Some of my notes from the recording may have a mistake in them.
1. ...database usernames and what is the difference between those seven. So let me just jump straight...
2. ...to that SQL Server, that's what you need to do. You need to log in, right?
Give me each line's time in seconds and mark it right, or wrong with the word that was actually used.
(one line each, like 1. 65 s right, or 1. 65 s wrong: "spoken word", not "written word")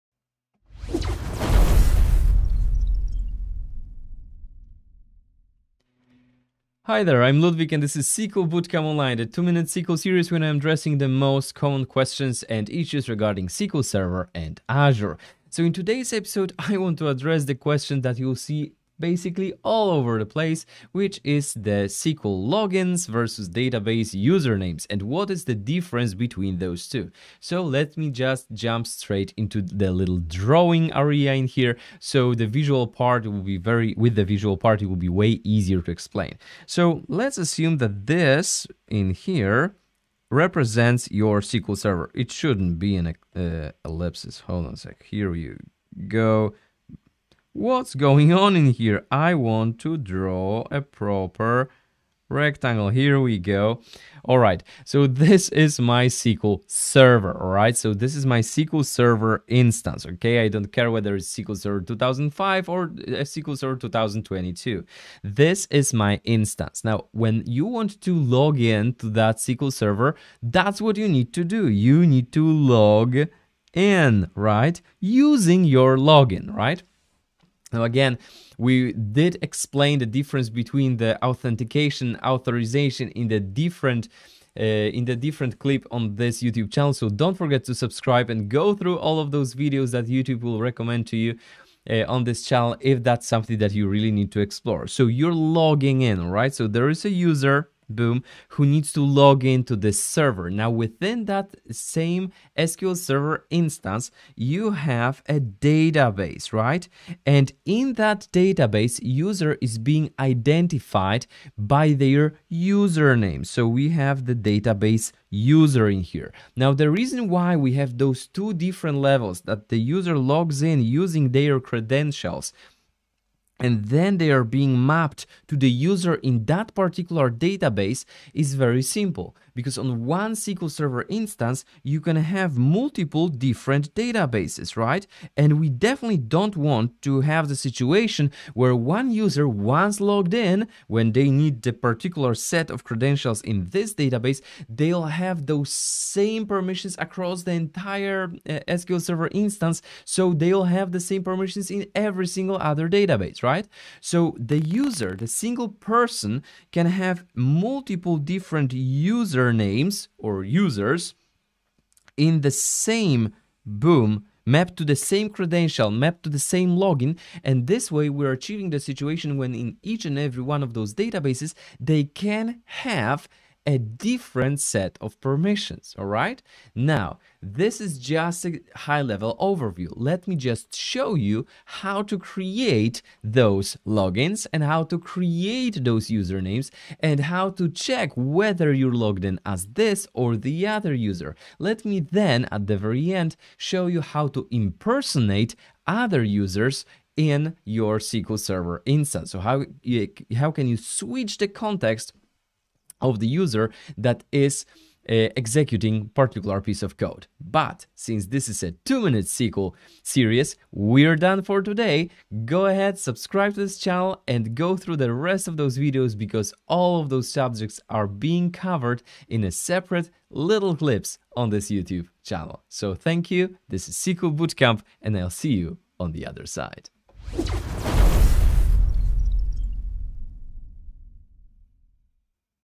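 1. 23 s wrong: "two", not "seven"
2. 68 s right.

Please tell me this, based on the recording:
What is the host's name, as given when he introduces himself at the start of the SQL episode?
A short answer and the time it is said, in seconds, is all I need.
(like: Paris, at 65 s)
Ludwik, at 7 s.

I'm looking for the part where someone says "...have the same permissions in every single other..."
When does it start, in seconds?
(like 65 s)
150 s.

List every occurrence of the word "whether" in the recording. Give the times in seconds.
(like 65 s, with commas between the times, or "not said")
60 s, 188 s.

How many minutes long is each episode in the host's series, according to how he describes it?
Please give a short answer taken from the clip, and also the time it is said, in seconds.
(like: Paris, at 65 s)
2, at 208 s.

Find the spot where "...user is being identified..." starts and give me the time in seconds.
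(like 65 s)
109 s.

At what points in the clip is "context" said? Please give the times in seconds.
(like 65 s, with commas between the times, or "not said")
201 s.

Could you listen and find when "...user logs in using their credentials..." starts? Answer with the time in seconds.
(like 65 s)
119 s.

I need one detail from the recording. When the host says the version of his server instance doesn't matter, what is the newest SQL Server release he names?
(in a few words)
SQL Server 2022.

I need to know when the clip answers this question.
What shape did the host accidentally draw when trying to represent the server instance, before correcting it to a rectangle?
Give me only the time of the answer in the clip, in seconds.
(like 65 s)
43 s.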